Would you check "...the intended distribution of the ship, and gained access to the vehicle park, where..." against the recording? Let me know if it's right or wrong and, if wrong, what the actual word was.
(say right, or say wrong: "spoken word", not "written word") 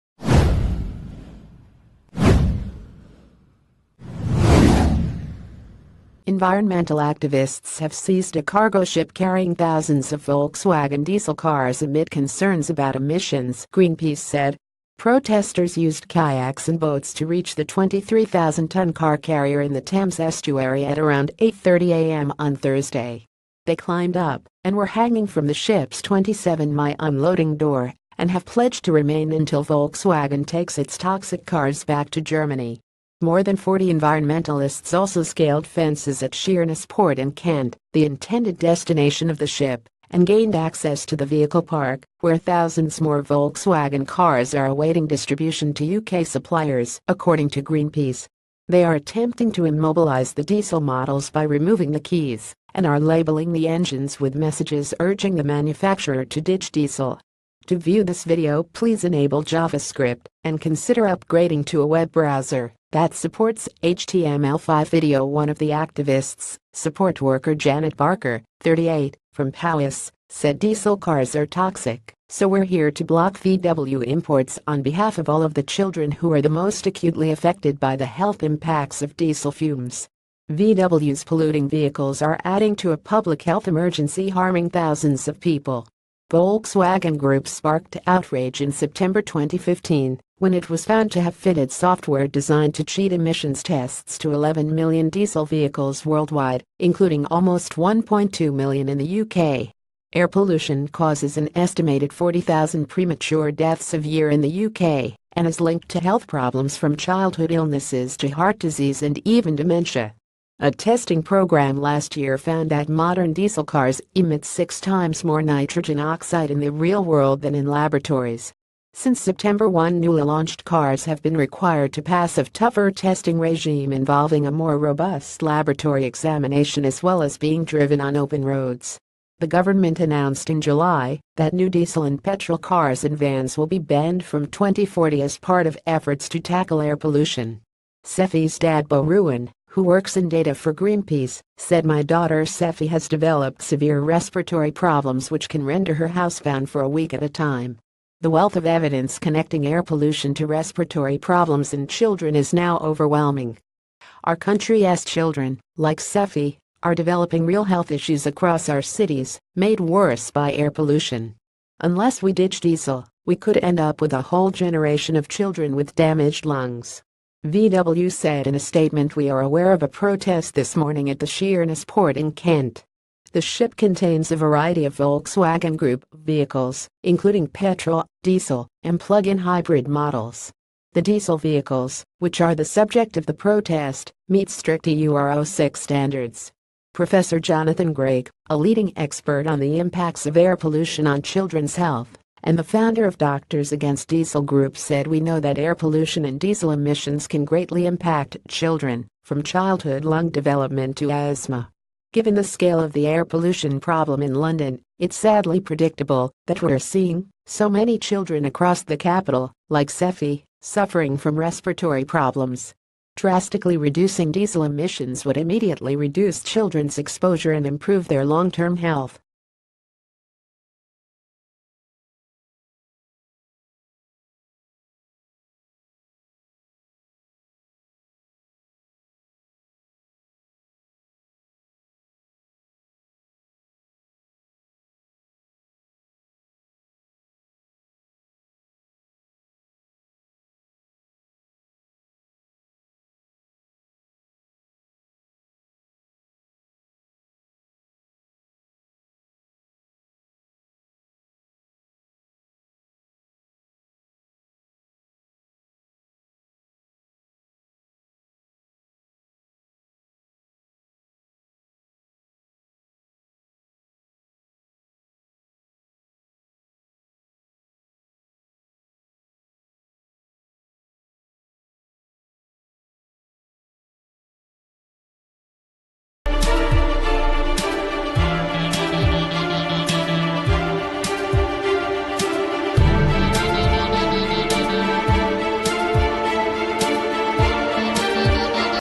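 wrong: "destination", not "distribution".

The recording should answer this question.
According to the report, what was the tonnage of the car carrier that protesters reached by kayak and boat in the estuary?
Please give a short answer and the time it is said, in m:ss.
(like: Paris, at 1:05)
23,000 tons, at 0:17.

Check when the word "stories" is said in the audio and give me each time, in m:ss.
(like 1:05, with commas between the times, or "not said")
not said.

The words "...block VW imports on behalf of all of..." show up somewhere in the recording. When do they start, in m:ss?
1:13.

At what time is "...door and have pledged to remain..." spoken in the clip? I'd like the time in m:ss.
0:27.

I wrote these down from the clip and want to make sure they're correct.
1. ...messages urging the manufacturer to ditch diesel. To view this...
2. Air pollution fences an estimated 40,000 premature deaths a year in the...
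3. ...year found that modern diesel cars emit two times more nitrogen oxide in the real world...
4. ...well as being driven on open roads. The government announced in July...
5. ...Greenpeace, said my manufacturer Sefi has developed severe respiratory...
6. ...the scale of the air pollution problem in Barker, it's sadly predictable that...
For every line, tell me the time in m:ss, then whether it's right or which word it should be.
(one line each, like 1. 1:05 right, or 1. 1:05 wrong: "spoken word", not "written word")
1. 0:54 right
2. 1:40 wrong: "causes", not "fences"
3. 1:52 wrong: "six", not "two"
4. 2:07 right
5. 2:20 wrong: "daughter", not "manufacturer"
6. 3:22 wrong: "London", not "Barker".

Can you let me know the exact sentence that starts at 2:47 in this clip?
VW said in a statement We are aware of a protest this morning at the Sheerness port in Kent.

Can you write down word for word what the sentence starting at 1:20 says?
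VW's polluting vehicles are adding to a public health emergency harming thousands of people.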